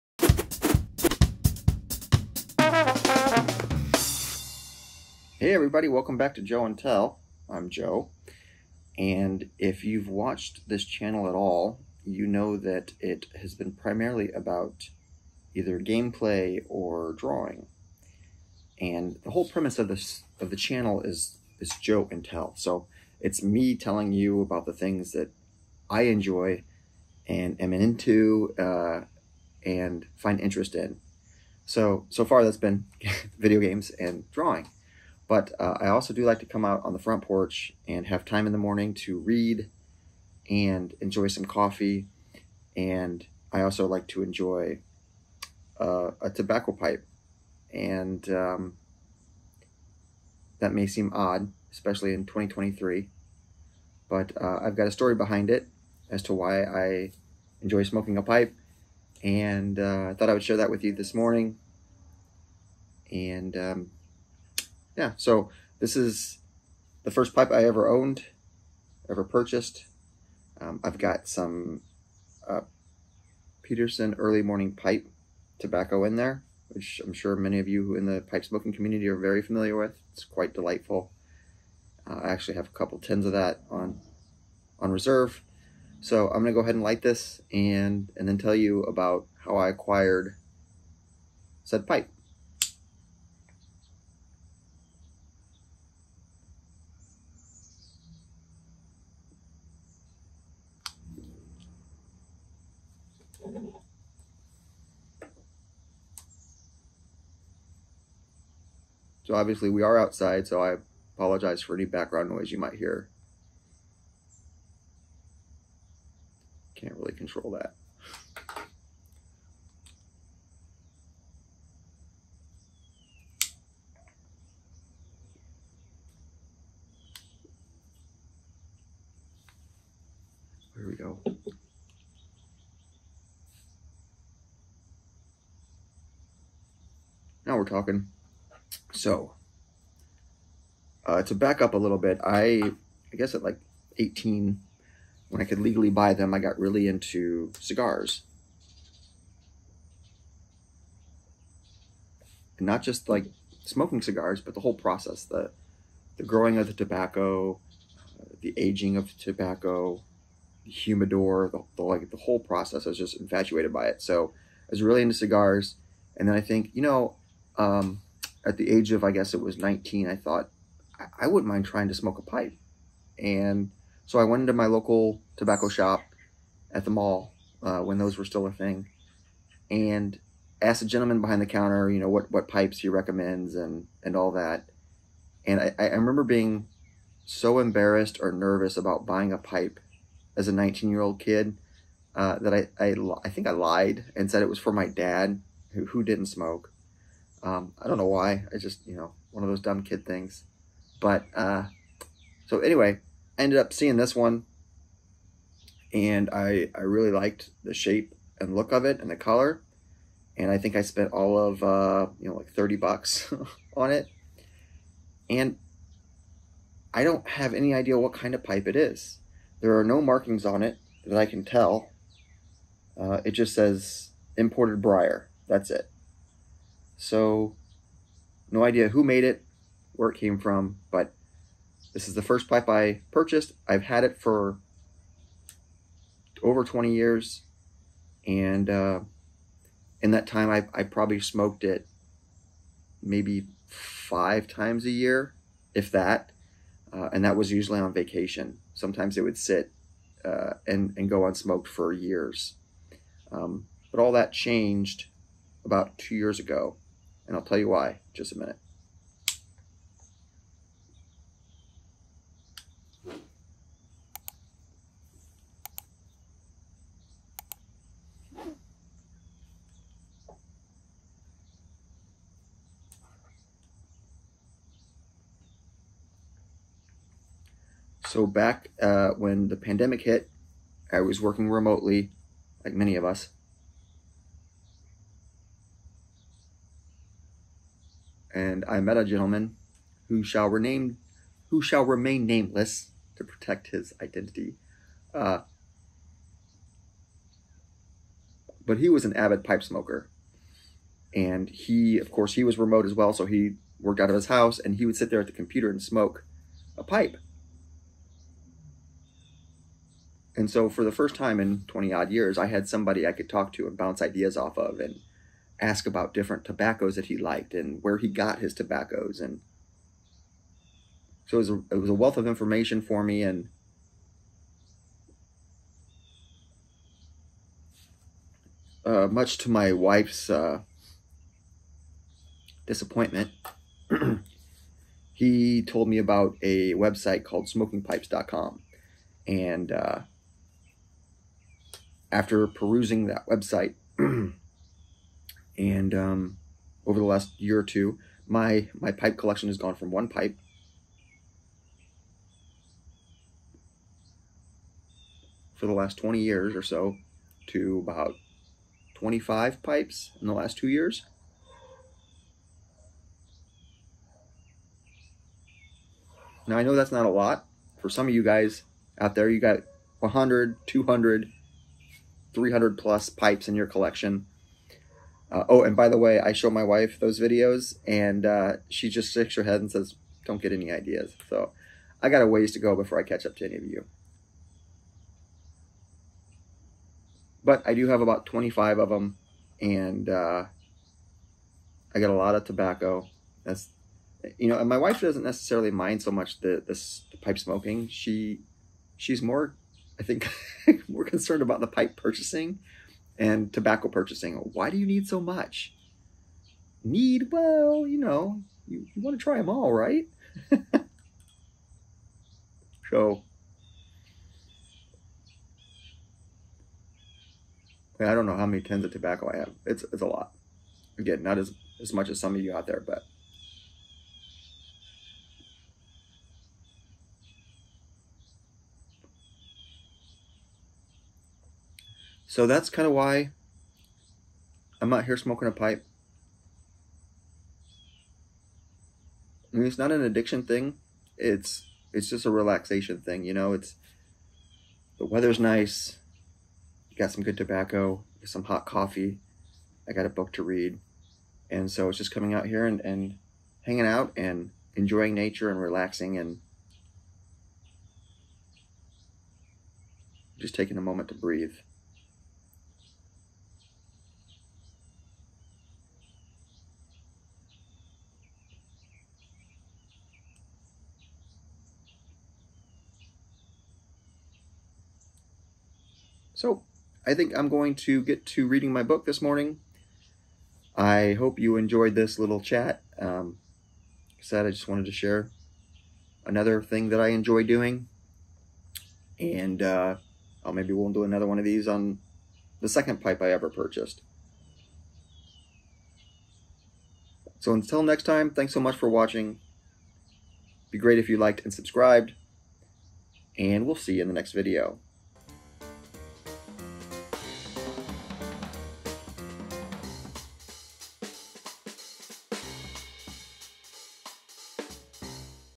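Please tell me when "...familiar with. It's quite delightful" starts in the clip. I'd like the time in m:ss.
1:19.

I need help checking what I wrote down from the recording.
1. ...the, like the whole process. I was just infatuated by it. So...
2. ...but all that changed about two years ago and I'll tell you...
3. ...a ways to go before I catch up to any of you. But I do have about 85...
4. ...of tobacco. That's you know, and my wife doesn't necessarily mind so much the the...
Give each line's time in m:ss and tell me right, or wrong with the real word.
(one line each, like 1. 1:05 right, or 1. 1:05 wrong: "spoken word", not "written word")
1. 2:41 right
2. 4:13 right
3. 6:22 wrong: "25", not "85"
4. 6:32 right.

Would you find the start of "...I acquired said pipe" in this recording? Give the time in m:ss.
1:29.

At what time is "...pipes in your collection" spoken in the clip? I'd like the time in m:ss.
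6:13.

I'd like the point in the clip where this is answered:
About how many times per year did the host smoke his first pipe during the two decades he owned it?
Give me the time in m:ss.
4:03.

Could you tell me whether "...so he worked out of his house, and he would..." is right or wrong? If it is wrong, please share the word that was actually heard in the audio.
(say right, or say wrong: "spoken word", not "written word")
right.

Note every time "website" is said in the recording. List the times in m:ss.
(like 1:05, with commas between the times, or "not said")
5:36, 5:43.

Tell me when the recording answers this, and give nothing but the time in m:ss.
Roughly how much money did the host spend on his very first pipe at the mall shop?
3:32.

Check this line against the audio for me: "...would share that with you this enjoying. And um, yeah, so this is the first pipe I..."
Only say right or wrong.
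wrong.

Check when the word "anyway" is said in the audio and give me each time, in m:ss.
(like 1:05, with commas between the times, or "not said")
3:22.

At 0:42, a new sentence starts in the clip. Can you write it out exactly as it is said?
And I also like to enjoy uh, a tobacco pipe.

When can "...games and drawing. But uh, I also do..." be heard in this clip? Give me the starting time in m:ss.
0:33.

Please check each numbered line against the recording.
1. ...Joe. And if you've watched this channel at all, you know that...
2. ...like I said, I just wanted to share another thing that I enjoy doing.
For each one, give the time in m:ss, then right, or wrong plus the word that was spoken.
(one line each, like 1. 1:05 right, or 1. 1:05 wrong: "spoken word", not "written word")
1. 0:07 right
2. 8:04 right.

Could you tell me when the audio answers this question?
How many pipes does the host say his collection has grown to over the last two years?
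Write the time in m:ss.
5:57.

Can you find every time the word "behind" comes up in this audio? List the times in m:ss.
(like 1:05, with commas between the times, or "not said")
0:55, 3:01.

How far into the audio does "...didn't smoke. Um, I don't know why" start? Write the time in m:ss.
3:16.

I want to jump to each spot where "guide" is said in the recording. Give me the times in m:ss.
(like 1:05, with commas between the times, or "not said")
not said.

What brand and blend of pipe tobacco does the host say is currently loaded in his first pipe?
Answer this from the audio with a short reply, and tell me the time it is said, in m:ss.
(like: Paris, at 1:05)
Peterson Early Morning, at 1:13.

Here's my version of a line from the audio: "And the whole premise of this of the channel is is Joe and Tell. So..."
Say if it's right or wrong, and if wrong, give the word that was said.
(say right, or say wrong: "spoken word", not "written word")
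right.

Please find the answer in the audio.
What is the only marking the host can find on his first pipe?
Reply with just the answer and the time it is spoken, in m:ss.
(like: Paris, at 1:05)
Imported briar, at 3:44.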